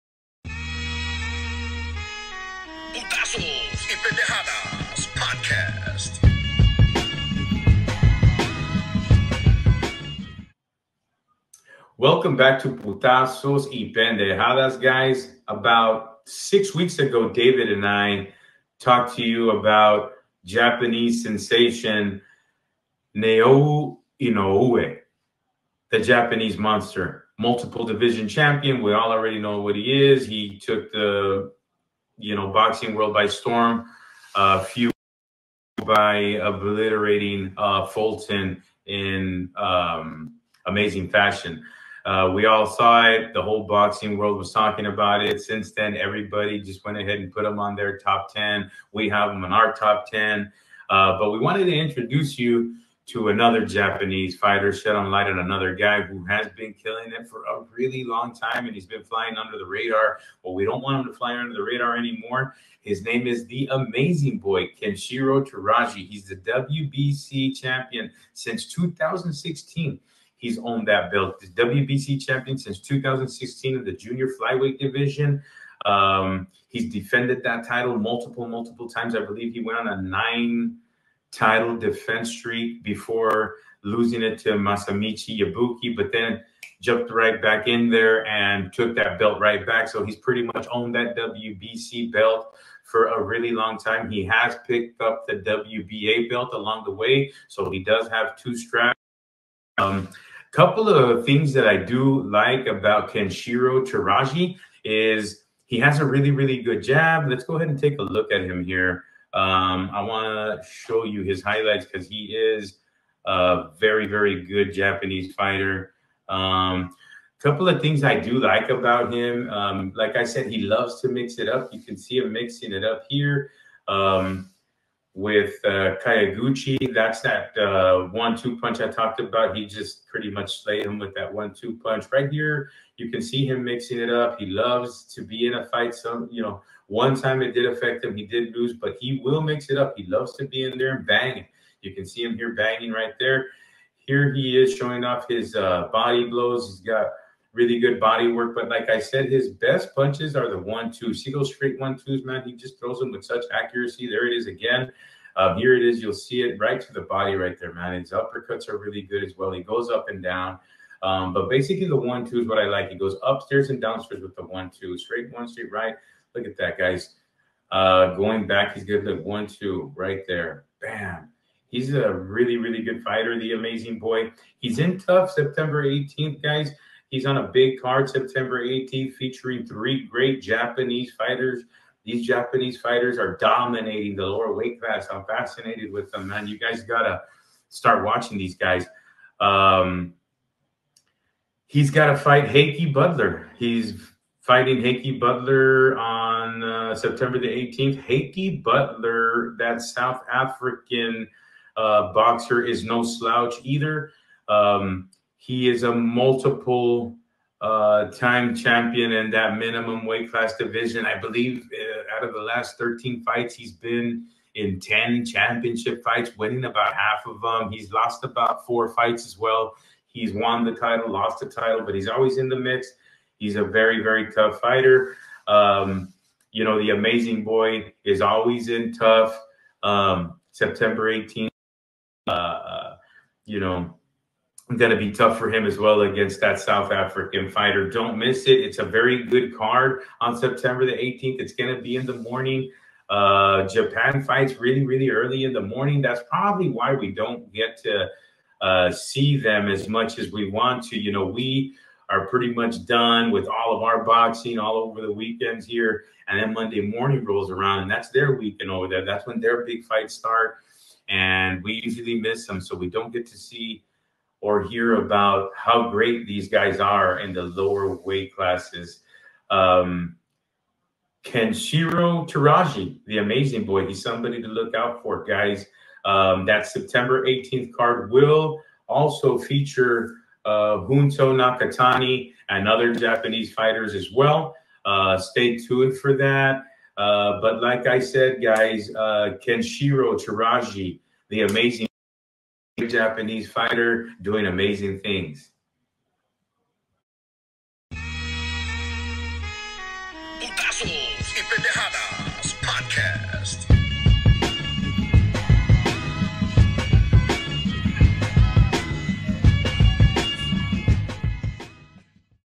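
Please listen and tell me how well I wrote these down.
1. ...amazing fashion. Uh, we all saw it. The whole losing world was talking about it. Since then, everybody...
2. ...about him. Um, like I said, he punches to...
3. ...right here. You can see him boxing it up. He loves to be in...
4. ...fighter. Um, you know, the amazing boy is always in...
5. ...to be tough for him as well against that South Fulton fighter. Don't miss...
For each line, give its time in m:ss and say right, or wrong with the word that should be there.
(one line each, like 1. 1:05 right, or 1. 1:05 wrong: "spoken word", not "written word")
1. 0:40 wrong: "boxing", not "losing"
2. 1:58 wrong: "loves", not "punches"
3. 2:12 wrong: "mixing", not "boxing"
4. 3:44 right
5. 3:54 wrong: "African", not "Fulton".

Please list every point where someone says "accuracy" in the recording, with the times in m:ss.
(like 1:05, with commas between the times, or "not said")
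2:33.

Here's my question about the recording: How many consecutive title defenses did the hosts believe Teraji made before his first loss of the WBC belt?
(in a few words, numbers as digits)
9.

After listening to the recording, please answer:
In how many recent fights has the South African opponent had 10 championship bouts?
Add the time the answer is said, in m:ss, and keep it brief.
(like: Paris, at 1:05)
13, at 3:32.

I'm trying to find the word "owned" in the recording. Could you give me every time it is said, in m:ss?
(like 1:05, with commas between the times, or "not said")
1:10, 1:30.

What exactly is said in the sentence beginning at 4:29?
Um, Kenshiro Teraji, the amazing boy, he's somebody to look out for, guys.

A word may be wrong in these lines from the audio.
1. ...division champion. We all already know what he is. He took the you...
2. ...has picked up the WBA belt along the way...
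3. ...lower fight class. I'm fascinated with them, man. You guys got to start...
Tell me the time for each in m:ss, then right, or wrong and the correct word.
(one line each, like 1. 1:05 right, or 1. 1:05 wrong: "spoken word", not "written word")
1. 0:27 right
2. 1:34 right
3. 3:04 wrong: "weight", not "fight".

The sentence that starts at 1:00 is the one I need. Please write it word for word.
Well, we don't want him to fly under the radar anymore.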